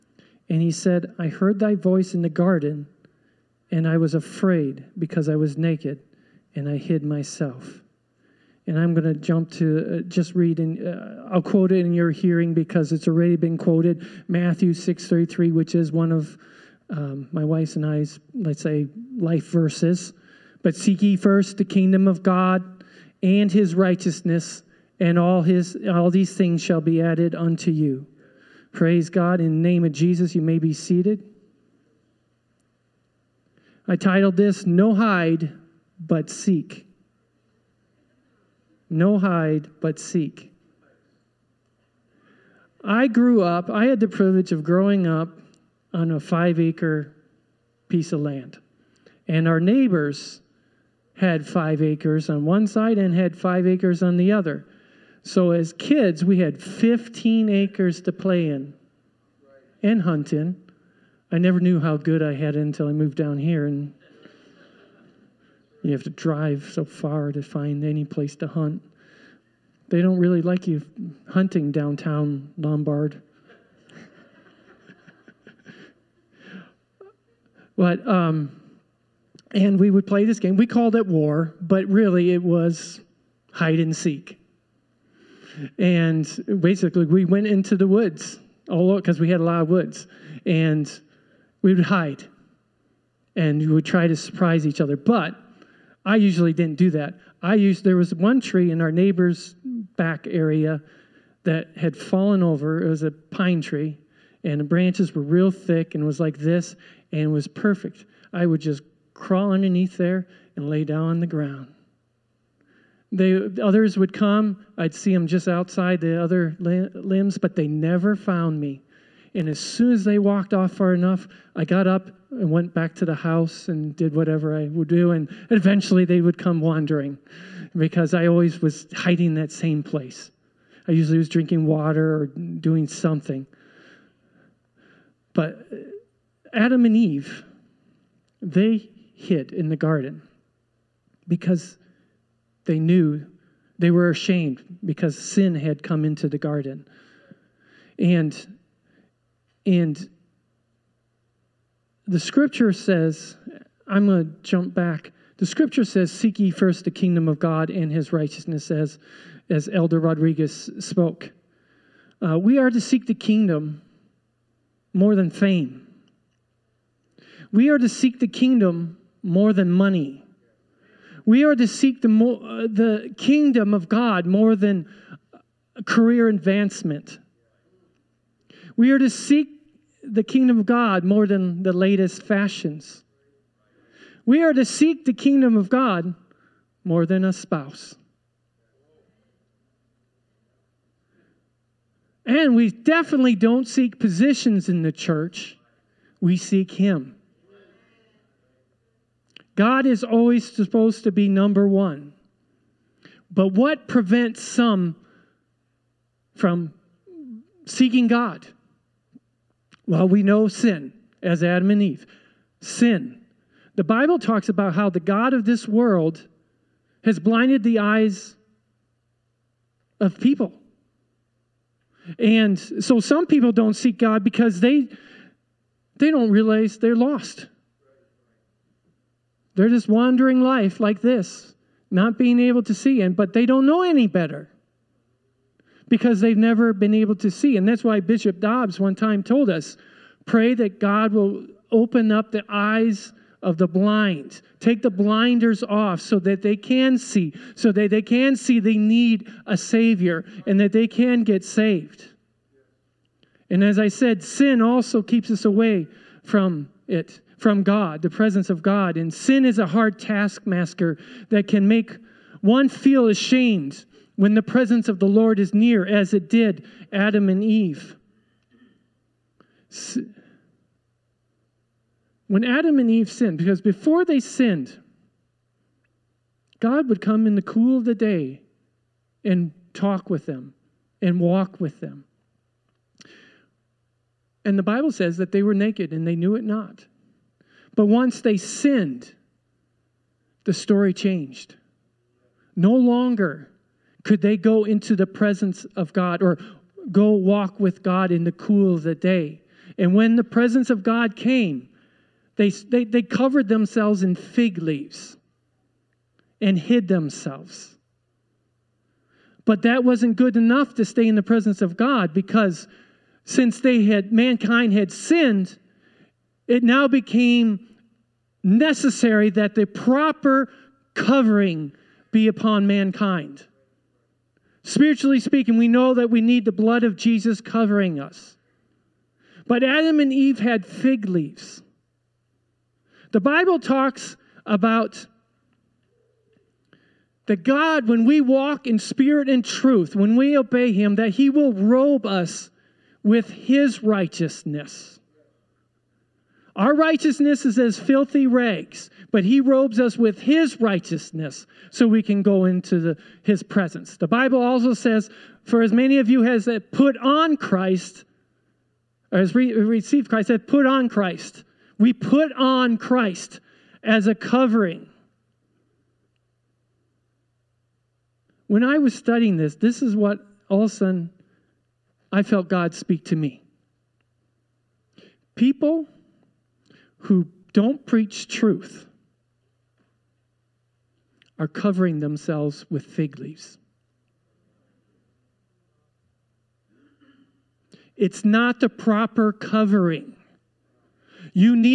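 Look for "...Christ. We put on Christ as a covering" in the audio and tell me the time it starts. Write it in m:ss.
6:00.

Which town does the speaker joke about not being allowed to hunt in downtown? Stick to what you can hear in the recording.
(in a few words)
Lombard.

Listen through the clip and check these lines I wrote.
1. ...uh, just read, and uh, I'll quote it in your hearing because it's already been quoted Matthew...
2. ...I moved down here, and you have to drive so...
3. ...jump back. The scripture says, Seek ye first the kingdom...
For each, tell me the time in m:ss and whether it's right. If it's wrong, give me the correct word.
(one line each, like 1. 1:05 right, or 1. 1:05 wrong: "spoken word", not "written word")
1. 0:09 right
2. 1:02 right
3. 2:34 right.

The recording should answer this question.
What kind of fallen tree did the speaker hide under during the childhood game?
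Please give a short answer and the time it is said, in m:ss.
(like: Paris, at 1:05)
Pine tree, at 1:43.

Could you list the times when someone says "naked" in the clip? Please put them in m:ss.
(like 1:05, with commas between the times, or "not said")
0:05, 4:45.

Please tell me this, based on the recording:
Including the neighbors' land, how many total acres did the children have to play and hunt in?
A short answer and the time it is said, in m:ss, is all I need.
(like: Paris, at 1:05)
15, at 0:56.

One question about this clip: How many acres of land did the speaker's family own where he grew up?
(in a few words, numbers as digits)
5.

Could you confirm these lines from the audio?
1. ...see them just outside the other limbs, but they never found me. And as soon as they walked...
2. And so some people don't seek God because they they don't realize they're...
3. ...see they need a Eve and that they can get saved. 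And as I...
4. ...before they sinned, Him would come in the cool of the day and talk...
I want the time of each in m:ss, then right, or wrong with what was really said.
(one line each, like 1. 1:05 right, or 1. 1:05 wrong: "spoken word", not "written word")
1. 1:54 right
2. 3:42 right
3. 4:08 wrong: "Savior", not "Eve"
4. 4:33 wrong: "God", not "Him".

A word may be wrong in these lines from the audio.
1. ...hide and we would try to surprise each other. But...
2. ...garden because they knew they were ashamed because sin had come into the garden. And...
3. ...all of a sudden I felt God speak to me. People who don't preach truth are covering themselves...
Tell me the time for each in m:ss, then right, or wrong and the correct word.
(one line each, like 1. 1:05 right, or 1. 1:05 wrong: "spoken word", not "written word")
1. 1:31 right
2. 2:19 right
3. 6:10 right.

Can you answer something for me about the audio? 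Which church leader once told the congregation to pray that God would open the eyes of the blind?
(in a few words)
Bishop Dobbs.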